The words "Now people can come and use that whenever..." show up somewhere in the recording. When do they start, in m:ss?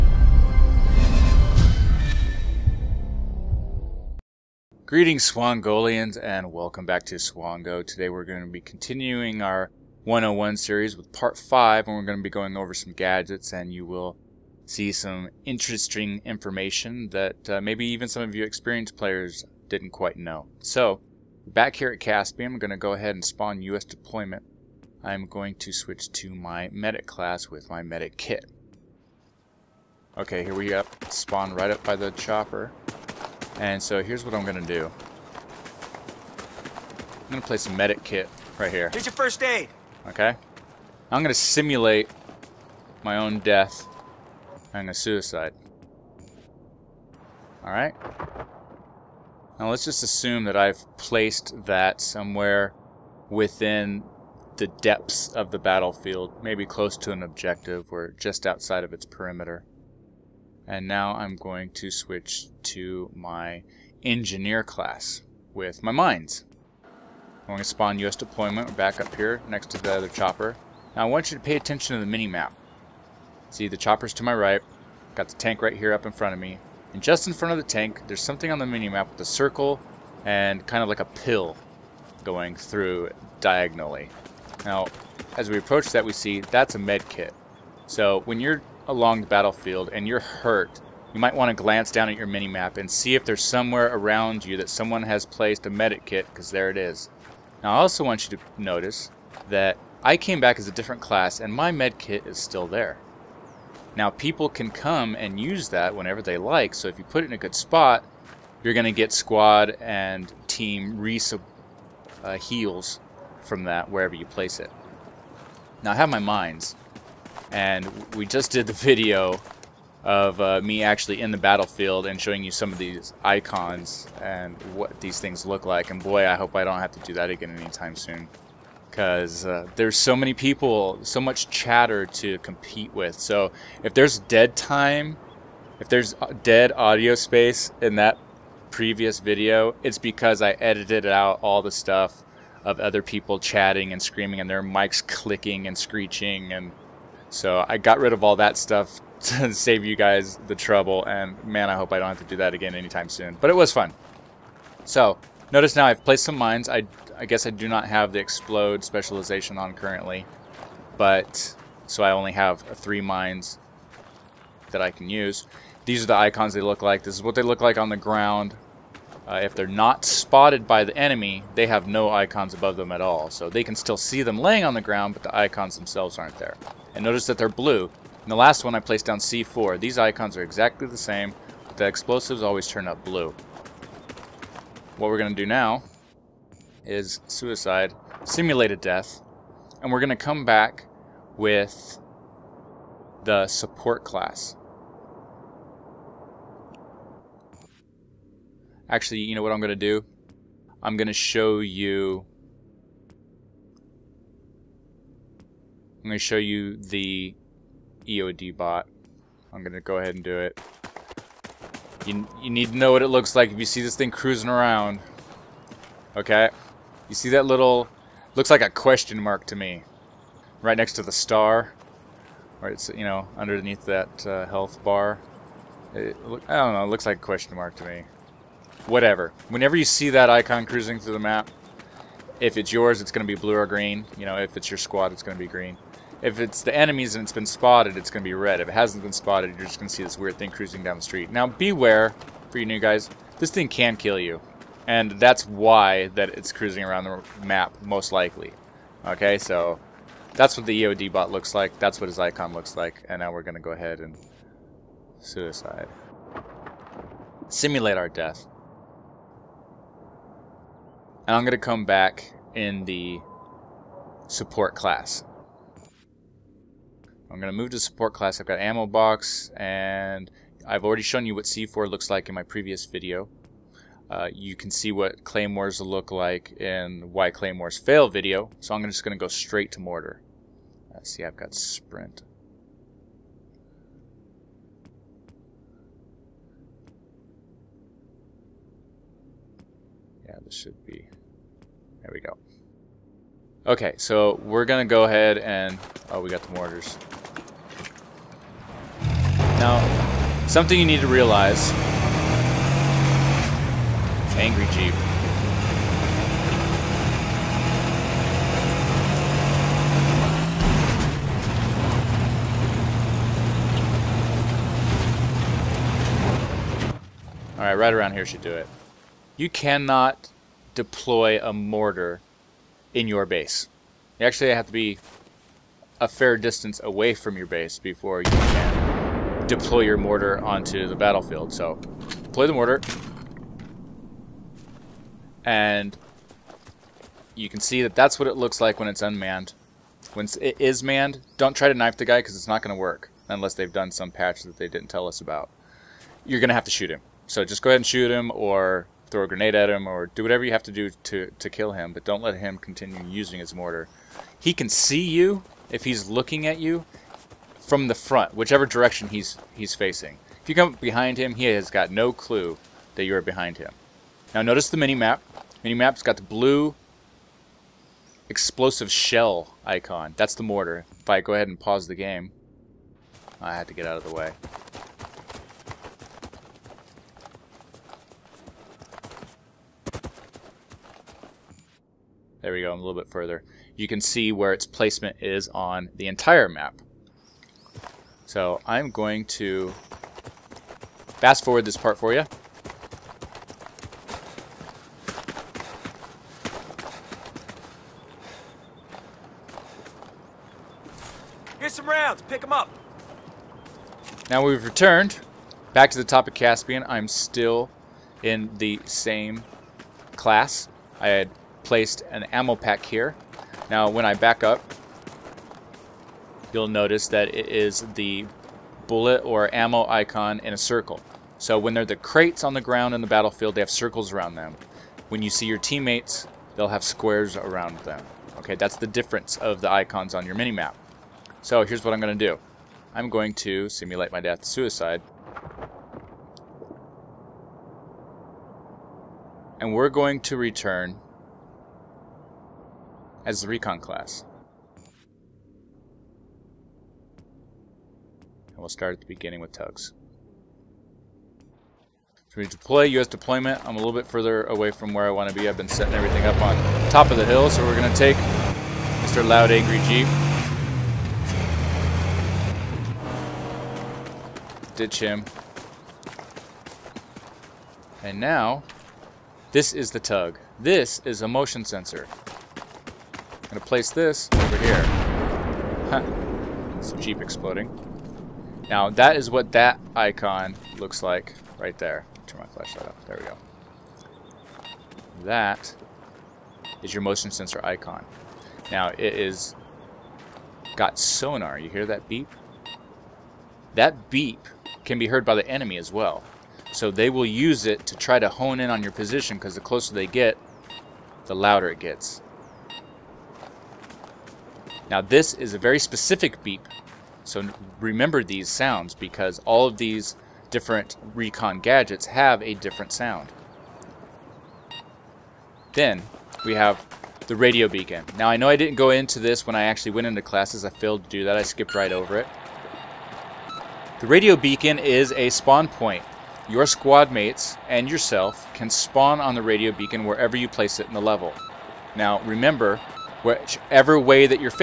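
1:43.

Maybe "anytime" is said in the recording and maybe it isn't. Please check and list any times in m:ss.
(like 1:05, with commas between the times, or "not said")
2:07, 2:32.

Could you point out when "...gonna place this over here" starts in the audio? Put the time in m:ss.
7:53.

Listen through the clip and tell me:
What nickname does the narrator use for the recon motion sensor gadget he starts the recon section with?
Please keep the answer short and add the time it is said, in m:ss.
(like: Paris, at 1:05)
Tugs, at 7:29.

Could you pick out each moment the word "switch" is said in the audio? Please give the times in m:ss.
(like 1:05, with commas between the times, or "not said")
0:25, 1:01.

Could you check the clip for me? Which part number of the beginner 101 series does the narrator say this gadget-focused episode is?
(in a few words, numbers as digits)
5.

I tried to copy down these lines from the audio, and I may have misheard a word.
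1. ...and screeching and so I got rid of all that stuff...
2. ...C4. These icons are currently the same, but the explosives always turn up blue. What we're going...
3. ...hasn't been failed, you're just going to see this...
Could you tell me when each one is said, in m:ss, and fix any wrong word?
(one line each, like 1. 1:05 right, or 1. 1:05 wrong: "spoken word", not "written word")
1. 2:25 right
2. 2:59 wrong: "exactly", not "currently"
3. 3:58 wrong: "spotted", not "failed".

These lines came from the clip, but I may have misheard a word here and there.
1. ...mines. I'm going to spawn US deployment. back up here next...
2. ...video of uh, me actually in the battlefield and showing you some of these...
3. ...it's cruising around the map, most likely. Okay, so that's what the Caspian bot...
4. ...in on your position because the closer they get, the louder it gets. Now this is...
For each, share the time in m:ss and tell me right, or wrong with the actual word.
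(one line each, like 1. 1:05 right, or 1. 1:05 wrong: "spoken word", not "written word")
1. 1:05 right
2. 1:58 right
3. 4:06 wrong: "EOD", not "Caspian"
4. 8:18 right.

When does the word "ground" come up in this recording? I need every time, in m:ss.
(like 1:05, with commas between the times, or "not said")
2:47, 2:54, 7:02.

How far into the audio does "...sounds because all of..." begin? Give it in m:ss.
8:28.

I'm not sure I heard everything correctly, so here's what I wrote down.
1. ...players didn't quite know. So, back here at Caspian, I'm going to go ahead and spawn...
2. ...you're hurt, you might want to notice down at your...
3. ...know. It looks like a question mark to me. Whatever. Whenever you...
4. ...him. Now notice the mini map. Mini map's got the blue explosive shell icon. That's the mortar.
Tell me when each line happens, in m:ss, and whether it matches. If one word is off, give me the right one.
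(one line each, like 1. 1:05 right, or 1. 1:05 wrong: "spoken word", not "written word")
1. 0:18 right
2. 1:30 wrong: "glance", not "notice"
3. 3:46 right
4. 6:03 right.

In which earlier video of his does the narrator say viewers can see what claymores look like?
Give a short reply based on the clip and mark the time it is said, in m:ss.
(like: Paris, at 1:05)
Why claymores fail, at 4:37.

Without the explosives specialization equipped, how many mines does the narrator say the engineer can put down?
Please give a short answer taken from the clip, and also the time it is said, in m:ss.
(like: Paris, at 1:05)
3, at 2:42.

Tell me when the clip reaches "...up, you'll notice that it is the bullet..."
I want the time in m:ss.
6:54.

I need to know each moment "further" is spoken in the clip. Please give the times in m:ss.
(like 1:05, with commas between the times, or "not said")
6:23, 7:34.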